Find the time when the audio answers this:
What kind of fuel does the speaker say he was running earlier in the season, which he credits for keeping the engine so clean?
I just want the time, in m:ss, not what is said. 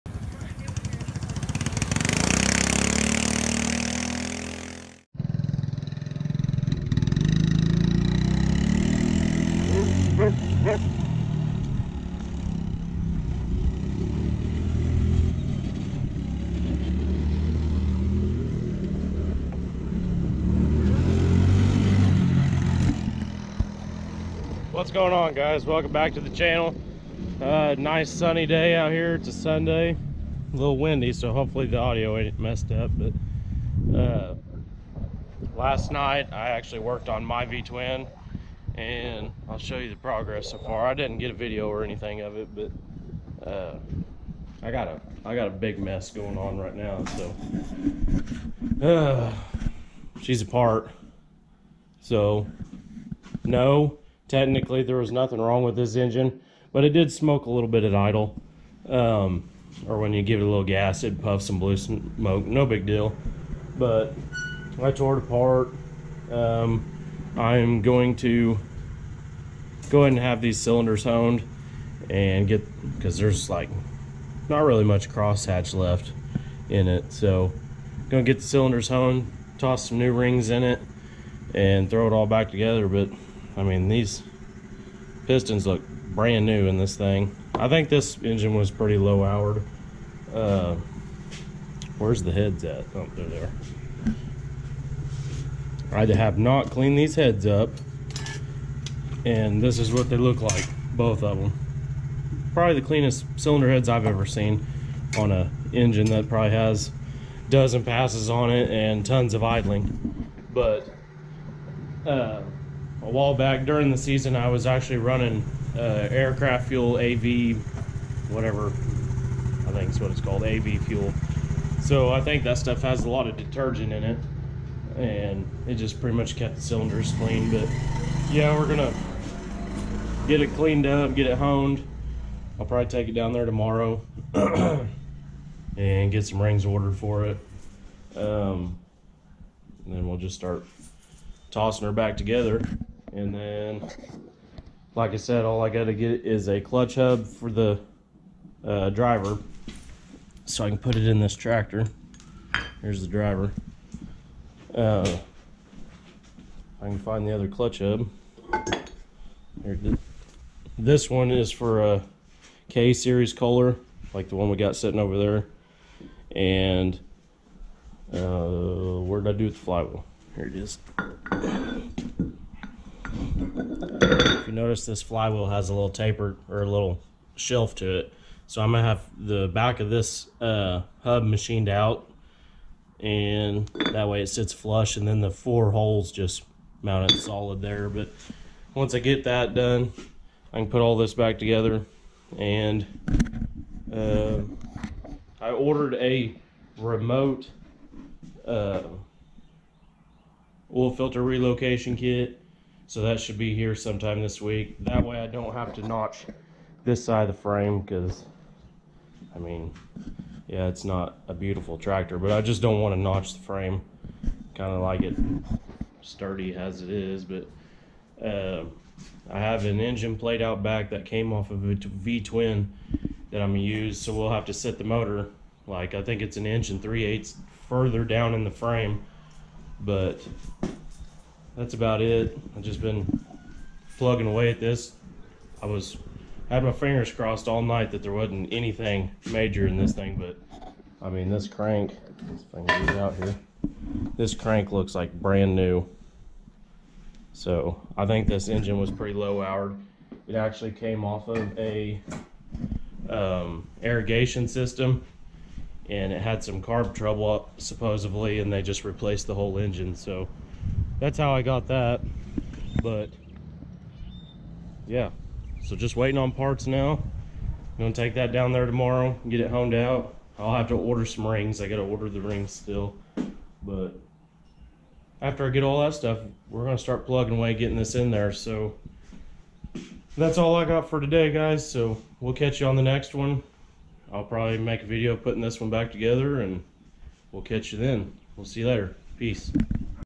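1:56.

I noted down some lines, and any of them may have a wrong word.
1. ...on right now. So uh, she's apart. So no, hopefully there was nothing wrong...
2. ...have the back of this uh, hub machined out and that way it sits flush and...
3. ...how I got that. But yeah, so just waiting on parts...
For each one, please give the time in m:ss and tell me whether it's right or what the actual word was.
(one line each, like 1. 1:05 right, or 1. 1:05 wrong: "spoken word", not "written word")
1. 0:46 wrong: "technically", not "hopefully"
2. 2:58 right
3. 4:21 right.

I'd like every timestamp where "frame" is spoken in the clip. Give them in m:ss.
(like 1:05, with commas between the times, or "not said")
3:27, 3:33, 3:48.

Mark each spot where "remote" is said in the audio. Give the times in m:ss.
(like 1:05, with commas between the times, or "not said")
3:16.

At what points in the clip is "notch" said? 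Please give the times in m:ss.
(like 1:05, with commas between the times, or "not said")
3:25, 3:32.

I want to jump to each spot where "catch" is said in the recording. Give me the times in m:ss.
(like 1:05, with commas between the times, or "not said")
4:42, 4:47.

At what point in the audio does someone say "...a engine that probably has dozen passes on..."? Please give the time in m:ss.
1:45.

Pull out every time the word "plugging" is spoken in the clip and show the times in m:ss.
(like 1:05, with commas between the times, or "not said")
3:53, 4:37.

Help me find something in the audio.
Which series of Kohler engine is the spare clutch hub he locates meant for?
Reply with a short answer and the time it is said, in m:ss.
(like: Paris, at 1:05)
K series, at 2:42.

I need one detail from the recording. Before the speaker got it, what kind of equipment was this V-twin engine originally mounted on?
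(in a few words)
irrigation system.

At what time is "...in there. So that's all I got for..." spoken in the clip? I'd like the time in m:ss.
4:37.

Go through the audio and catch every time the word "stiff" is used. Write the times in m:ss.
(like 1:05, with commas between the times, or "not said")
not said.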